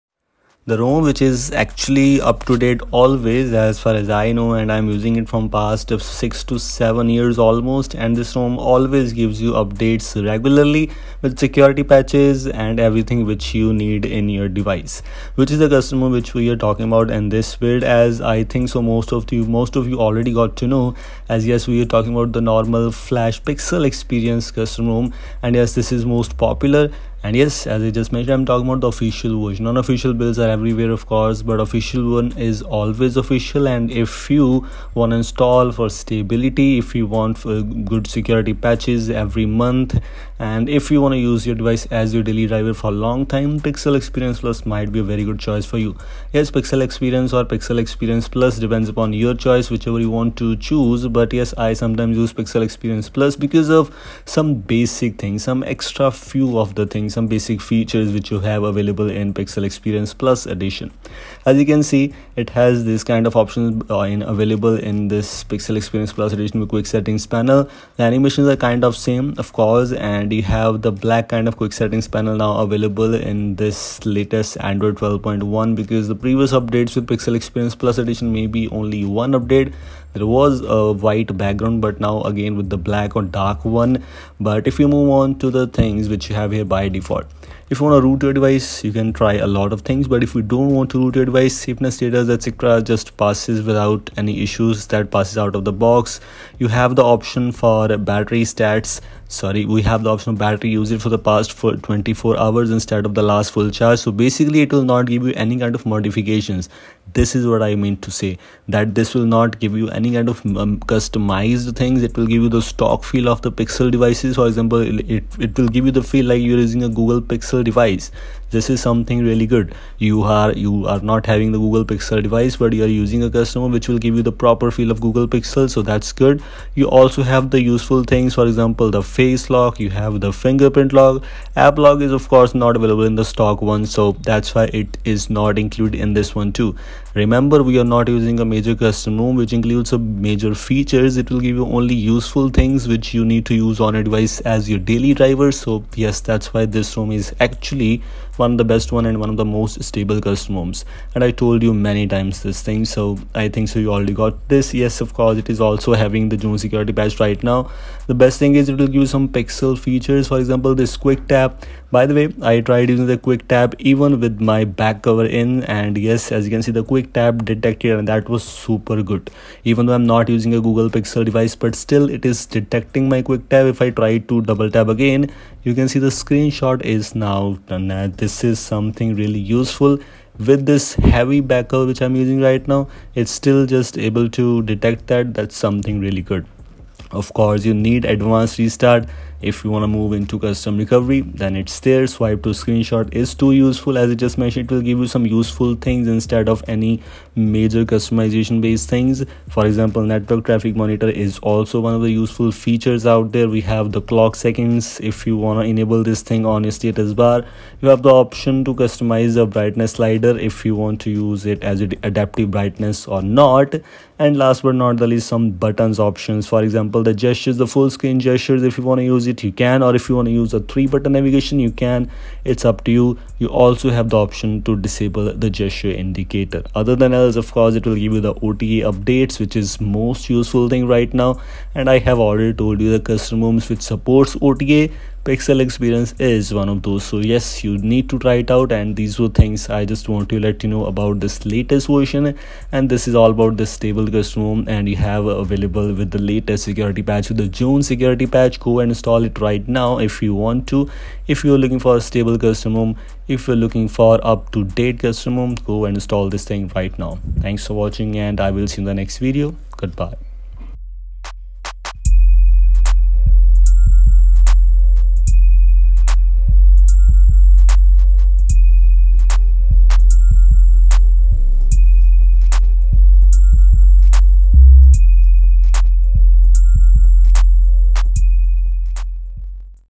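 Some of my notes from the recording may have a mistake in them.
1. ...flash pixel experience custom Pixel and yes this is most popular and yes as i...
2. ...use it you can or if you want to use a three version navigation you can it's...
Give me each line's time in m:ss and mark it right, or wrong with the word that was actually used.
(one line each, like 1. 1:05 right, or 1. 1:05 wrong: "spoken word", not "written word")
1. 0:22 wrong: "ROM", not "Pixel"
2. 3:39 wrong: "button", not "version".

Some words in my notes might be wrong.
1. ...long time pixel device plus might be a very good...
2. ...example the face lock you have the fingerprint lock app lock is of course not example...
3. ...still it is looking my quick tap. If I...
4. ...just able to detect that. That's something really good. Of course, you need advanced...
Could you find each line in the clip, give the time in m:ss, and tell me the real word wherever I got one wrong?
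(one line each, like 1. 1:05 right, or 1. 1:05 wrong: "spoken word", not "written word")
1. 0:43 wrong: "experience", not "device"
2. 2:08 wrong: "available", not "example"
3. 2:51 wrong: "detecting", not "looking"
4. 3:03 right.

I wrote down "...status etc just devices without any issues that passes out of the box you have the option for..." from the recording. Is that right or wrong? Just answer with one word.
wrong.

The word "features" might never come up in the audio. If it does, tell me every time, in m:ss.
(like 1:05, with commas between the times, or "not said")
0:57, 2:20, 2:39, 3:22.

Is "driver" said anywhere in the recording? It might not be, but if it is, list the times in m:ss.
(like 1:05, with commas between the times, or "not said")
0:42, 2:25.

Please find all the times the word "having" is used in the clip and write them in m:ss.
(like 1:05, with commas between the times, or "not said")
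2:01, 2:36.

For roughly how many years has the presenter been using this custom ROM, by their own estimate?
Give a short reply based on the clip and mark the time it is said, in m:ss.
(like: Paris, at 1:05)
6 to 7 years, at 0:05.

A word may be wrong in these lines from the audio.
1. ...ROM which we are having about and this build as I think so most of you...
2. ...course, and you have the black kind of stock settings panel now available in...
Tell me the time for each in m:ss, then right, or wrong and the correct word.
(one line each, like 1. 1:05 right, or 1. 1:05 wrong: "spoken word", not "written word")
1. 0:16 wrong: "talking", not "having"
2. 1:09 wrong: "quick", not "stock".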